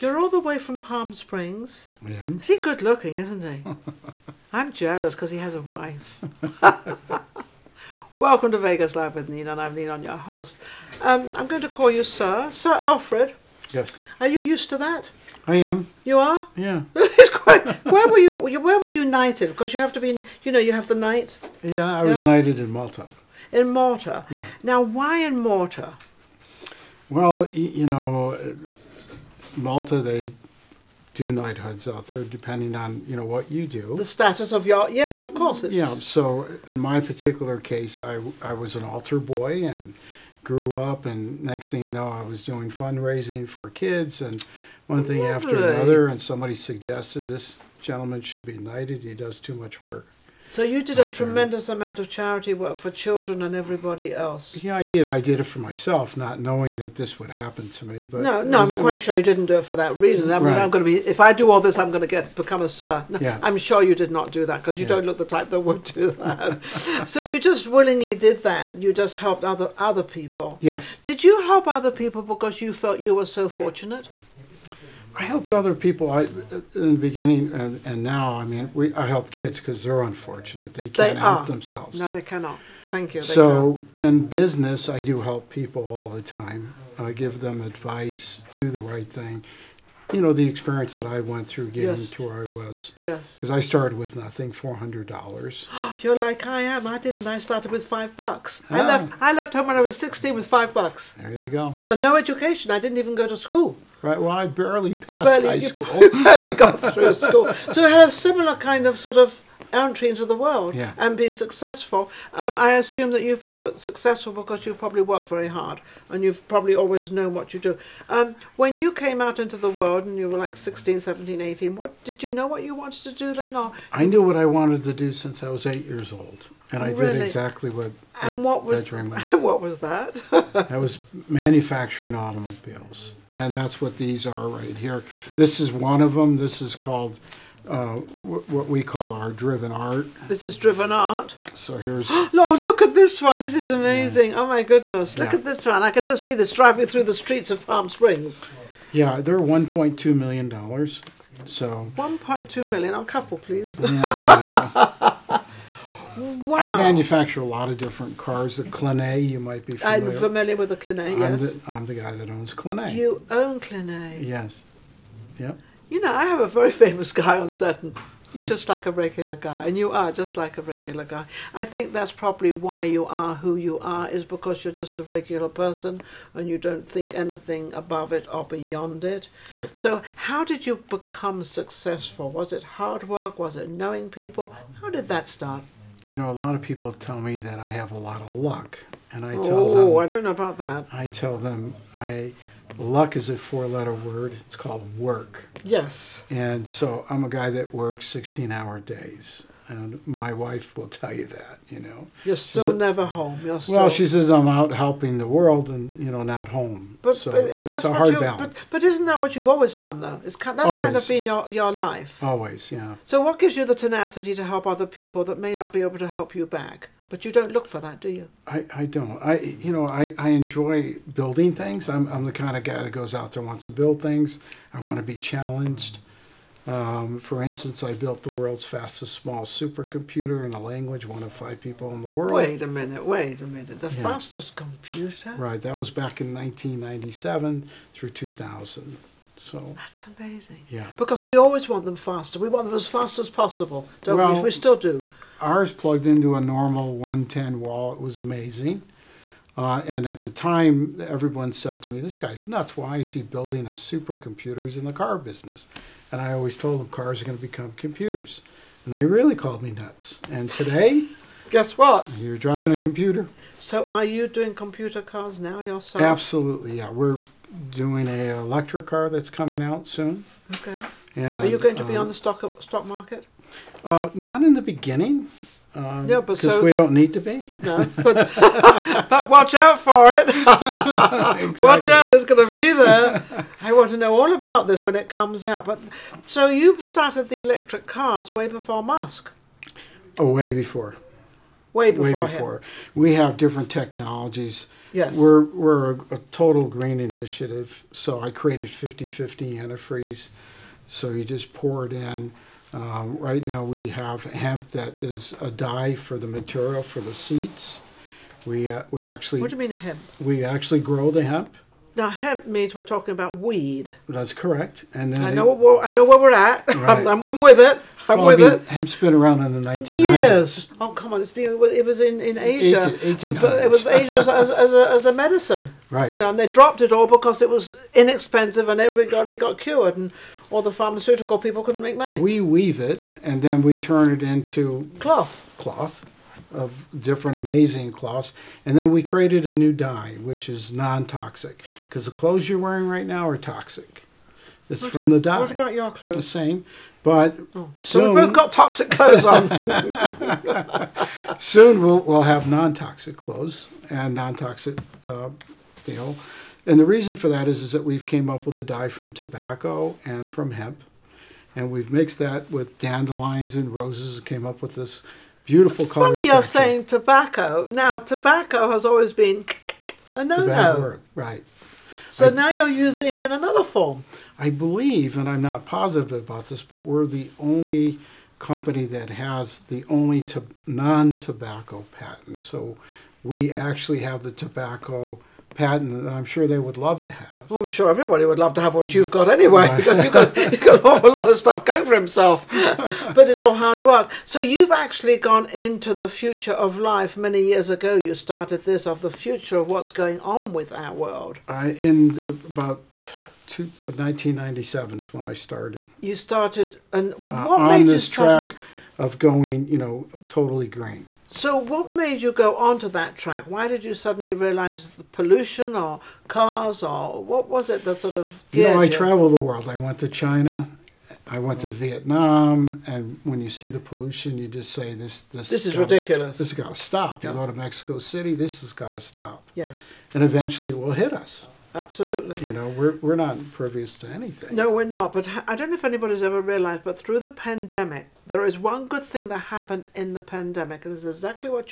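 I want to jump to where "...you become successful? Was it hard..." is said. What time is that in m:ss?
3:00.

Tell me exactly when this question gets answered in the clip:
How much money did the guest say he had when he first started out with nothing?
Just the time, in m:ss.
1:34.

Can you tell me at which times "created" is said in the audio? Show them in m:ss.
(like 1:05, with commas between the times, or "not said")
4:58, 5:39.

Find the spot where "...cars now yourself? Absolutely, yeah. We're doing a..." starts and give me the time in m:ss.
4:25.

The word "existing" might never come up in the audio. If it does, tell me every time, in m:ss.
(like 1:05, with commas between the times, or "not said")
not said.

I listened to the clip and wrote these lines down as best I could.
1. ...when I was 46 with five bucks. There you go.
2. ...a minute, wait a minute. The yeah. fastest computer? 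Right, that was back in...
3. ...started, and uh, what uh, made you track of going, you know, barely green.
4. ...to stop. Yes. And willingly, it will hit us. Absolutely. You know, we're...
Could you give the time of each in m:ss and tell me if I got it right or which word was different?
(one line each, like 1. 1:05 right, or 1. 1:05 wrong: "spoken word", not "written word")
1. 1:39 wrong: "16", not "46"
2. 3:52 right
3. 6:46 wrong: "totally", not "barely"
4. 7:08 wrong: "eventually", not "willingly".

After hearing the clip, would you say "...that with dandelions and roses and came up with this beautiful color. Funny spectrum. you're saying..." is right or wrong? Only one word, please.
right.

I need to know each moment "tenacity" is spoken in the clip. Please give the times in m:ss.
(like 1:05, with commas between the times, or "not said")
3:33.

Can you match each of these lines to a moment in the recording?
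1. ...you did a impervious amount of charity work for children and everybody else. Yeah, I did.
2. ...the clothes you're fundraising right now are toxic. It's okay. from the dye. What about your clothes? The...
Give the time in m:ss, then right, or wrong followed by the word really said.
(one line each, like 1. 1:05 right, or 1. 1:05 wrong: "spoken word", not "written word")
1. 0:50 wrong: "tremendous", not "impervious"
2. 5:42 wrong: "wearing", not "fundraising".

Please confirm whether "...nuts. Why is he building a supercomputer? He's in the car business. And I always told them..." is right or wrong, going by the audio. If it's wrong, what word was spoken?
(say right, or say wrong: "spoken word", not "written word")
right.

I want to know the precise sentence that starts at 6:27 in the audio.
Well, I'm sure everybody would love to have what you've got anyway, right.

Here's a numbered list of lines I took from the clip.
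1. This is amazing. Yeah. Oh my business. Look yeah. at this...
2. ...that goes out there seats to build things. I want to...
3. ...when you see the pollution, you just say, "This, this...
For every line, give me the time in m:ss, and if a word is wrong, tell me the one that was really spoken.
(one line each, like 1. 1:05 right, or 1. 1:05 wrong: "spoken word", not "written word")
1. 2:23 wrong: "goodness", not "business"
2. 3:42 wrong: "wants", not "seats"
3. 7:03 right.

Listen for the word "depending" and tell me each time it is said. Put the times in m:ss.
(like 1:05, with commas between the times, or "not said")
0:32.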